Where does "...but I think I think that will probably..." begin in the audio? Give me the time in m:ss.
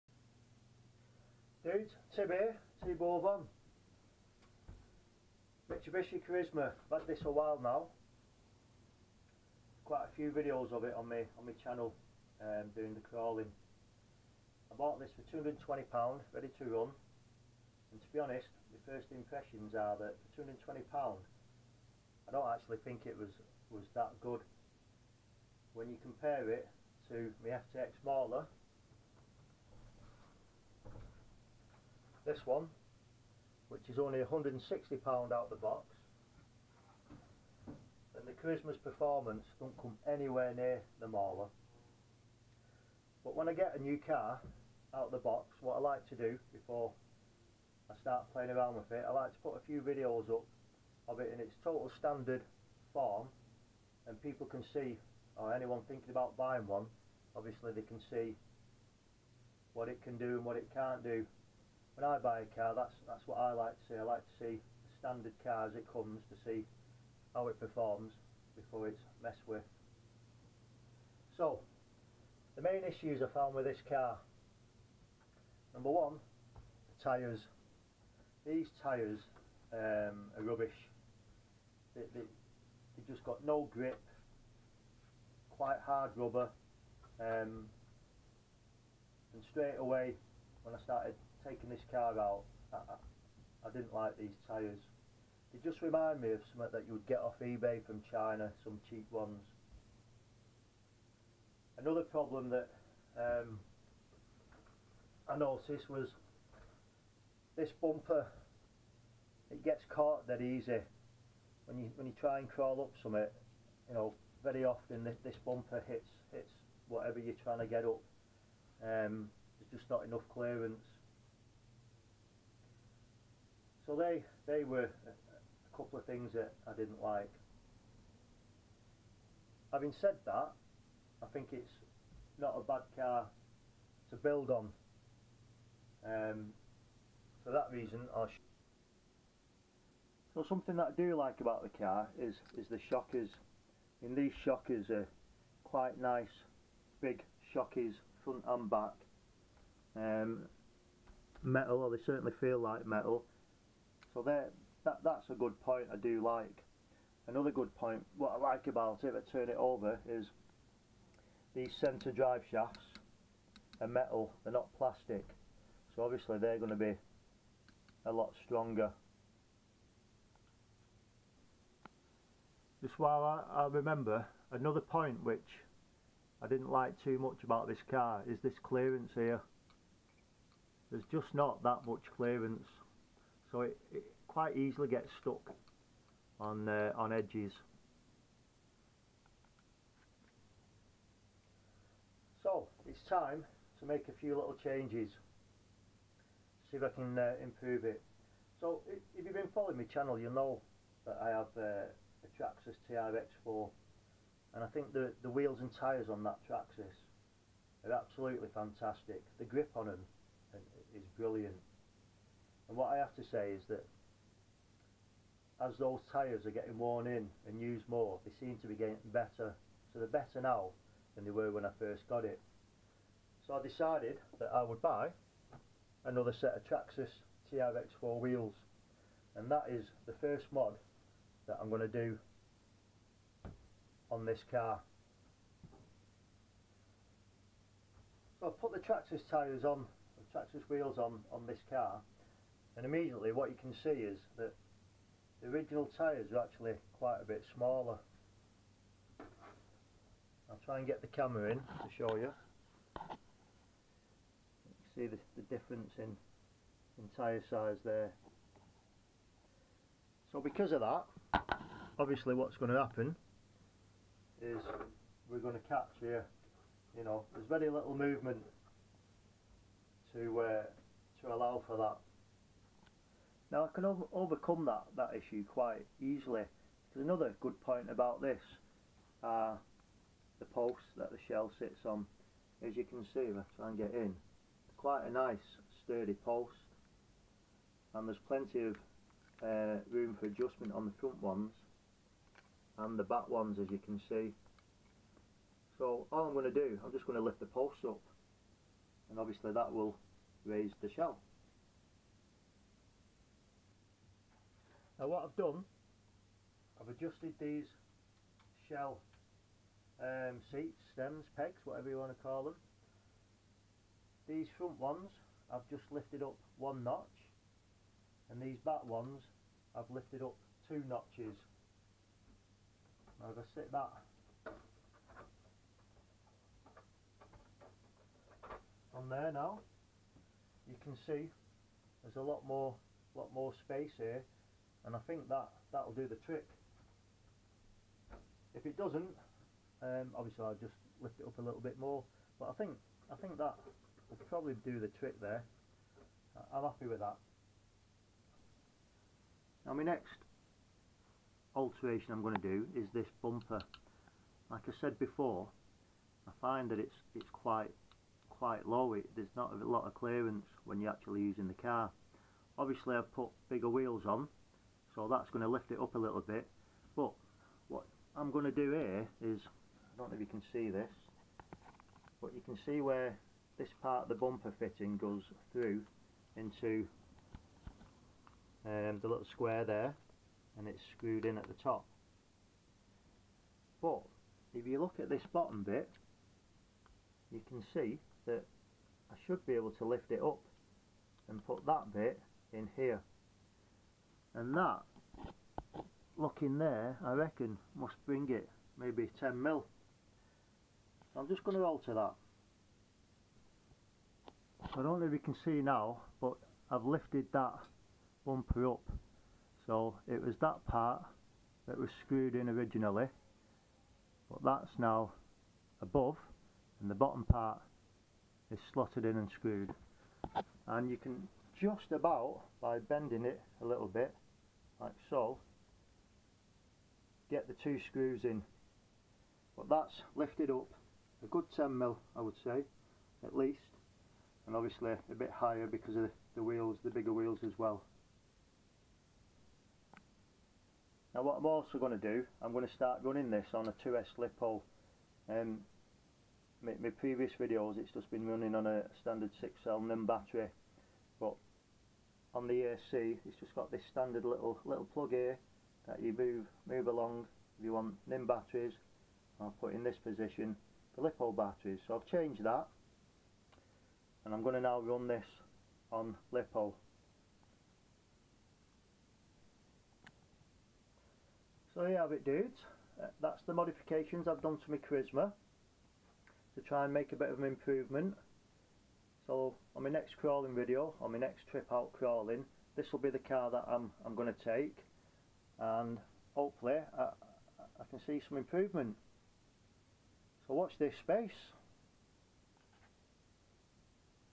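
5:42.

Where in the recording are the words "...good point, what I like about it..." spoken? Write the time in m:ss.
2:37.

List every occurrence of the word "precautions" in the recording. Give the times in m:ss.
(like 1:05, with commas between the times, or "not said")
not said.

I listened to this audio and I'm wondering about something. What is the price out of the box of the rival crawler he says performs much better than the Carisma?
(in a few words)
£160.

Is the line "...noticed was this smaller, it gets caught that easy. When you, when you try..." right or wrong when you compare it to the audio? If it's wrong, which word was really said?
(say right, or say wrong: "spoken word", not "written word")
wrong: "bumper", not "smaller".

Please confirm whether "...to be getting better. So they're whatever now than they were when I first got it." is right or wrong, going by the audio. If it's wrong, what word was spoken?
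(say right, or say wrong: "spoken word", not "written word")
wrong: "better", not "whatever".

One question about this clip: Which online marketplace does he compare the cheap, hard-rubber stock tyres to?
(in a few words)
eBay.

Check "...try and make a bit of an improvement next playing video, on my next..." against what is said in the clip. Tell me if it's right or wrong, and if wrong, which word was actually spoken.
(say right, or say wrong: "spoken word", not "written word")
wrong: "crawling", not "playing".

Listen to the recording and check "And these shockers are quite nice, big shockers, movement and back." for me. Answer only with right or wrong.
wrong.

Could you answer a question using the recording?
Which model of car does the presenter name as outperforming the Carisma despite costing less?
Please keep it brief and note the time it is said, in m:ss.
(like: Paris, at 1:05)
FTX Mauler, at 0:27.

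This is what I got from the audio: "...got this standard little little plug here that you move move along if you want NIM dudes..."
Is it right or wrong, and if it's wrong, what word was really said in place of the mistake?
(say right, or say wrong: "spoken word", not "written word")
wrong: "batteries", not "dudes".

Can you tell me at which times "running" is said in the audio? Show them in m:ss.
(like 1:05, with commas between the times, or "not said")
7:23, 7:28.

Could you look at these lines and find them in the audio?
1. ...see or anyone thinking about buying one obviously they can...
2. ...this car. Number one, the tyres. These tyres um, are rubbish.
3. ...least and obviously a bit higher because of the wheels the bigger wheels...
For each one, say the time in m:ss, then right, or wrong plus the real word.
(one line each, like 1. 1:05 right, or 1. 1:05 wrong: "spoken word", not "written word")
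1. 0:54 right
2. 1:13 right
3. 7:13 right.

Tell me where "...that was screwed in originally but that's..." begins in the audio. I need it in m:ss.
6:51.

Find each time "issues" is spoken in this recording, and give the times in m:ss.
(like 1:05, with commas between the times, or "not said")
1:12, 4:35.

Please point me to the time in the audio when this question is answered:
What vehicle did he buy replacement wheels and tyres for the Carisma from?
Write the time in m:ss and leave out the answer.
3:22.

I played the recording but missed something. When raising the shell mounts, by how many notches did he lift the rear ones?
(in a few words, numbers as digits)
2.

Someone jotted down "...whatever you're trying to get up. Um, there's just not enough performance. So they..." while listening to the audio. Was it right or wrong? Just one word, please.
wrong.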